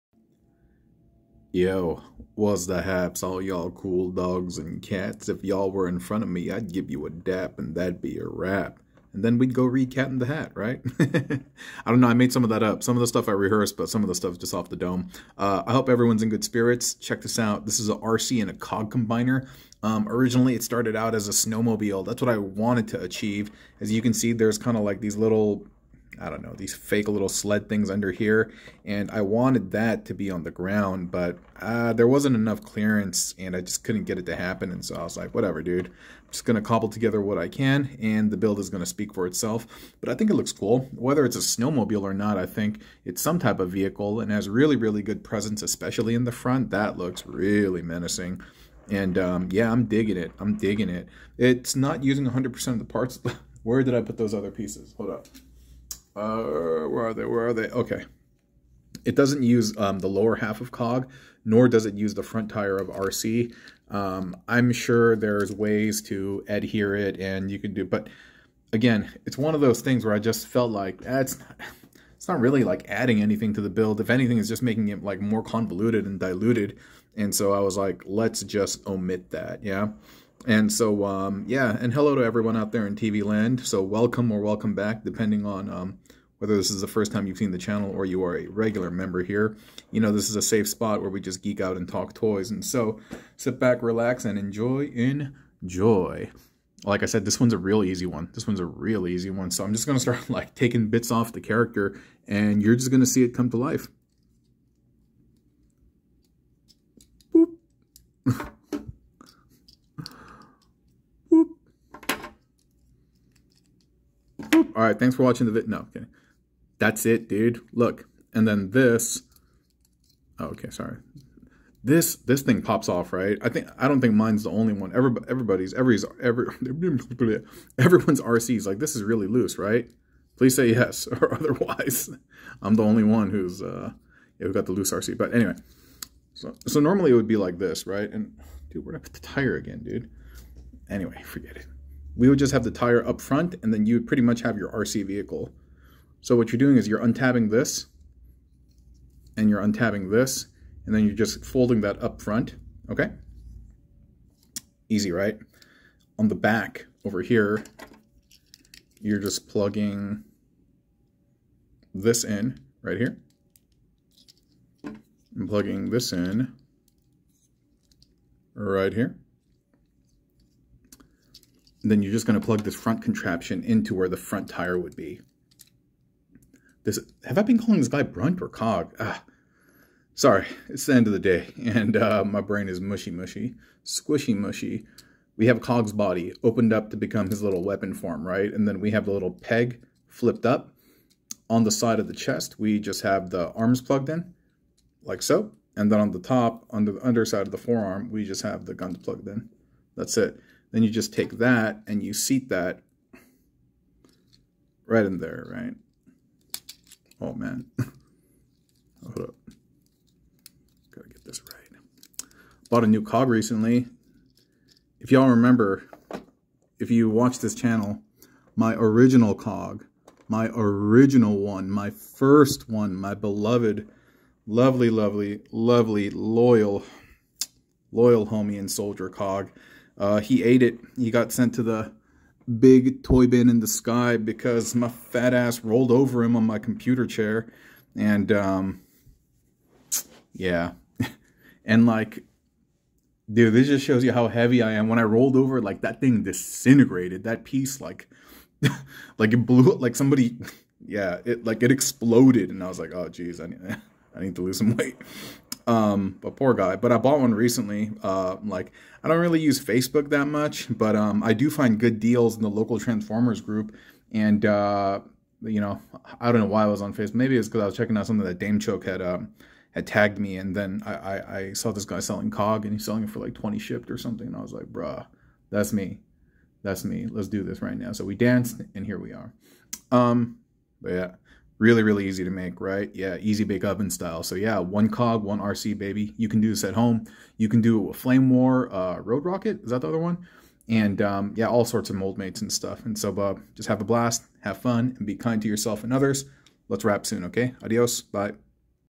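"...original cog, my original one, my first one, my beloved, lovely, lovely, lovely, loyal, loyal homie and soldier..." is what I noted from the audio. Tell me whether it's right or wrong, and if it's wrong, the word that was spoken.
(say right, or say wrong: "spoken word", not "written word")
right.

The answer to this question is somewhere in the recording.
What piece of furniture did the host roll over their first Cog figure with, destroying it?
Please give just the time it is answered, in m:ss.
3:56.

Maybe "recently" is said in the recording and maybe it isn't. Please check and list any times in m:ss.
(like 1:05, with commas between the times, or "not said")
3:33, 4:17.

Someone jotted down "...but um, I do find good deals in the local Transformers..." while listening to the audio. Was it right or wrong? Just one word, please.
right.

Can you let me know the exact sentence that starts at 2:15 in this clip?
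But anyway, so so normally it would be like this, right?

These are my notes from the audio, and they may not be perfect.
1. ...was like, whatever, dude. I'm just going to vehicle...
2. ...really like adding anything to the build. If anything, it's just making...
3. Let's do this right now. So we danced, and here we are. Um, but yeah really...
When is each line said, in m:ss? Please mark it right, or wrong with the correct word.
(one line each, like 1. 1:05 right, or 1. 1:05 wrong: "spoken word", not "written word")
1. 0:35 wrong: "cobble", not "vehicle"
2. 1:12 right
3. 4:37 right.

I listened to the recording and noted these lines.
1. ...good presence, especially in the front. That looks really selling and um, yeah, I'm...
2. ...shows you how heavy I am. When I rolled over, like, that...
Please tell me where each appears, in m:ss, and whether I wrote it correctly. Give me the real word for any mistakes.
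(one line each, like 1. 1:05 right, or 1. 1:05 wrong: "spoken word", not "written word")
1. 0:45 wrong: "menacing", not "selling"
2. 4:03 right.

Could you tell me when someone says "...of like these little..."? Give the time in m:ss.
0:24.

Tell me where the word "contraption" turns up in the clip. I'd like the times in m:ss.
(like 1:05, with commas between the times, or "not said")
2:53.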